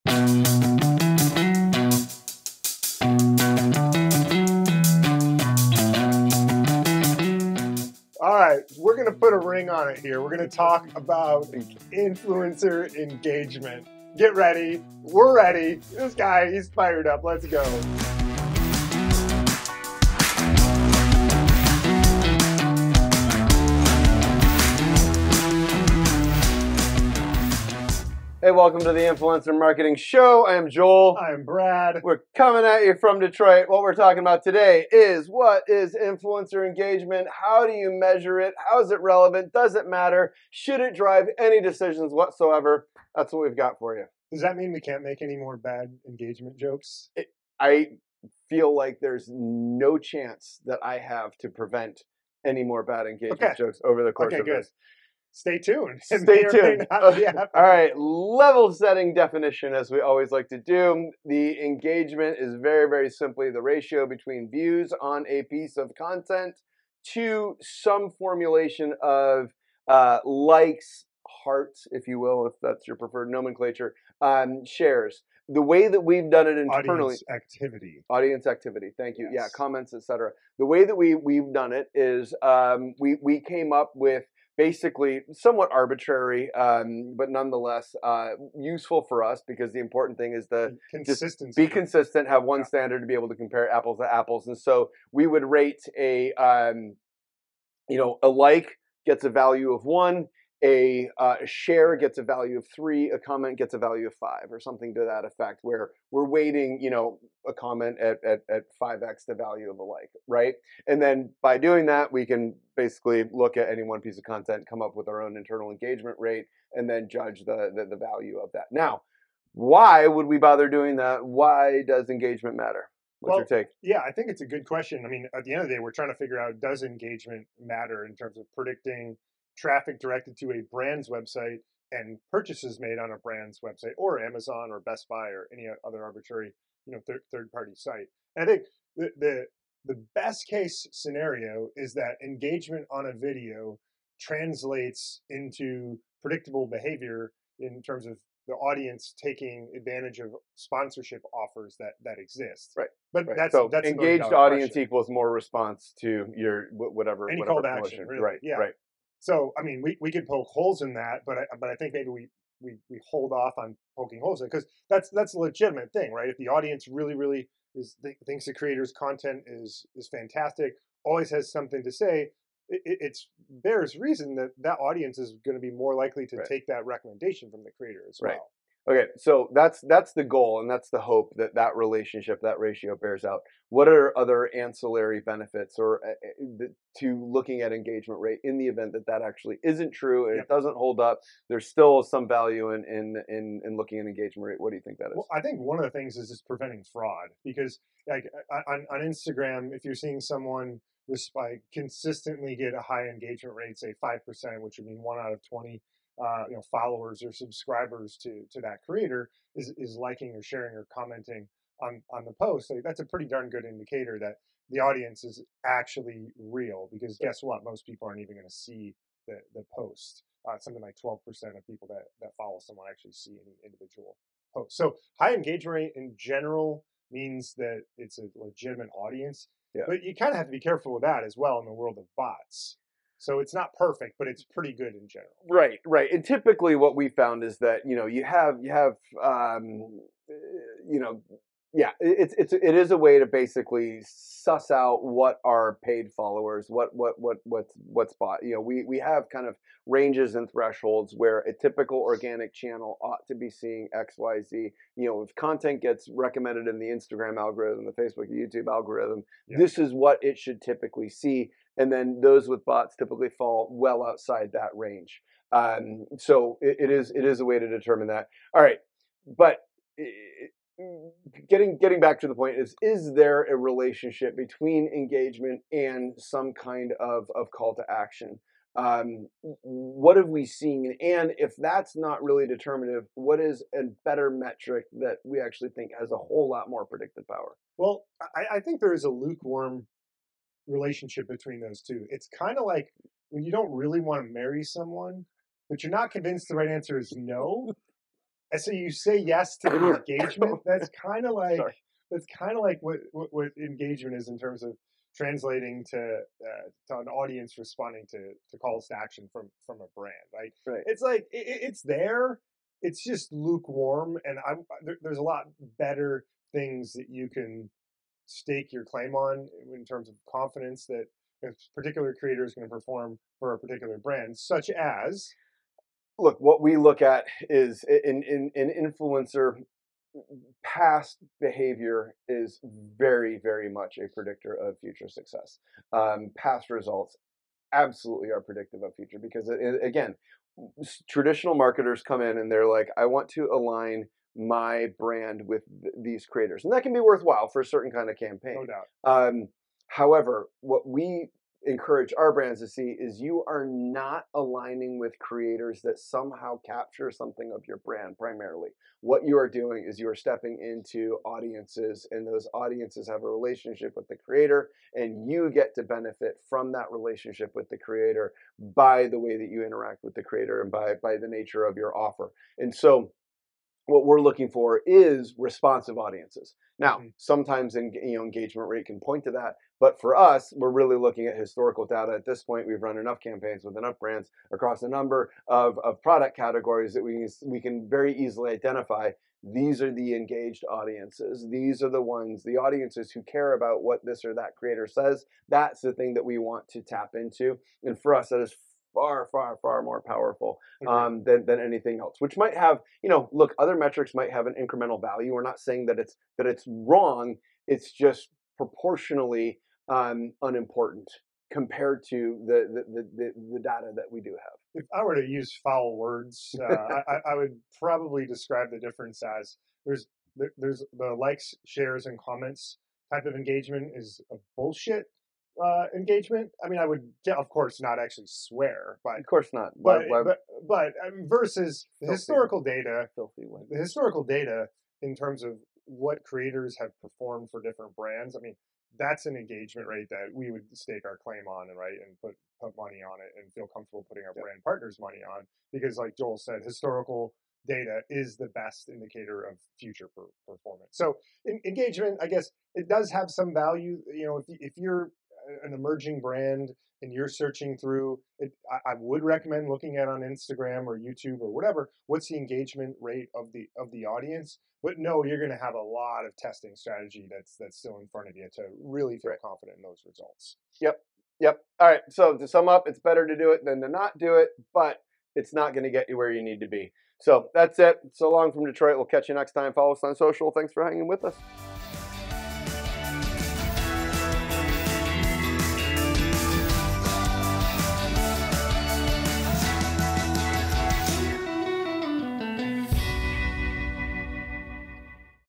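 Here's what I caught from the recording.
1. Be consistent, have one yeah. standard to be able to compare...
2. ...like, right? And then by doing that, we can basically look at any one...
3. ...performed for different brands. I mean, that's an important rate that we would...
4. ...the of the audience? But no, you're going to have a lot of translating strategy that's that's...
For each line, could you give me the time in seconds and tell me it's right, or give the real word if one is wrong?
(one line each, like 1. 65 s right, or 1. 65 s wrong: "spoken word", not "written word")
1. 91 s right
2. 109 s right
3. 437 s wrong: "engagement", not "important"
4. 463 s wrong: "testing", not "translating".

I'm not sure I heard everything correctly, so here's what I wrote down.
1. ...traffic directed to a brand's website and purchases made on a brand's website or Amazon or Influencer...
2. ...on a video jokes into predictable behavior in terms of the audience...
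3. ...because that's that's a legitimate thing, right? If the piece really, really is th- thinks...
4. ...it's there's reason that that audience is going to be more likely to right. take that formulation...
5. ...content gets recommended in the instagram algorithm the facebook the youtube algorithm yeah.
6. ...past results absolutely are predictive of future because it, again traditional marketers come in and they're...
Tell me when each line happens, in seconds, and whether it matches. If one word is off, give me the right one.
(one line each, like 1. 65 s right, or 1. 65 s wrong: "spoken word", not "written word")
1. 129 s wrong: "Best", not "Influencer"
2. 142 s wrong: "translates", not "jokes"
3. 164 s wrong: "audience", not "piece"
4. 172 s wrong: "recommendation", not "formulation"
5. 255 s right
6. 336 s right.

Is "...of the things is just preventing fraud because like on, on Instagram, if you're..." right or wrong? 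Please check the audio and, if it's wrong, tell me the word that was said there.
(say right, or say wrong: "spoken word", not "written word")
right.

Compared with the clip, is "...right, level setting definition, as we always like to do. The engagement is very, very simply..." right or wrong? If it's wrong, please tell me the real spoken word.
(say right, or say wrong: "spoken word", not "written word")
right.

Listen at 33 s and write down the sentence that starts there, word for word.
What we're talking about today is what is influencer engagement?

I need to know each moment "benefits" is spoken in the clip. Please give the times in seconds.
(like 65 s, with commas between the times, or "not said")
185 s, 365 s.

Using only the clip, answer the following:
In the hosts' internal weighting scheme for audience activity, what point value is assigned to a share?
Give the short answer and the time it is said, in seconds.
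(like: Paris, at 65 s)
3, at 102 s.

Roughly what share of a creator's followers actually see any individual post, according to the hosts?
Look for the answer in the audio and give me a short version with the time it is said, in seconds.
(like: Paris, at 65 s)
12%, at 221 s.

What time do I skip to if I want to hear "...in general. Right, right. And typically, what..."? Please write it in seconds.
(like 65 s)
234 s.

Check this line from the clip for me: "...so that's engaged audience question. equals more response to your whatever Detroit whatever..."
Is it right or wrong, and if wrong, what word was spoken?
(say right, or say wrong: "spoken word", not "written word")
wrong: "Any", not "Detroit".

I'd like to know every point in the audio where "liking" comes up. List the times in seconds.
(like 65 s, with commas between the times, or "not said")
209 s.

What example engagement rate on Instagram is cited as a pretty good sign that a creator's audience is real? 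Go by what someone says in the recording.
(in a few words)
5%.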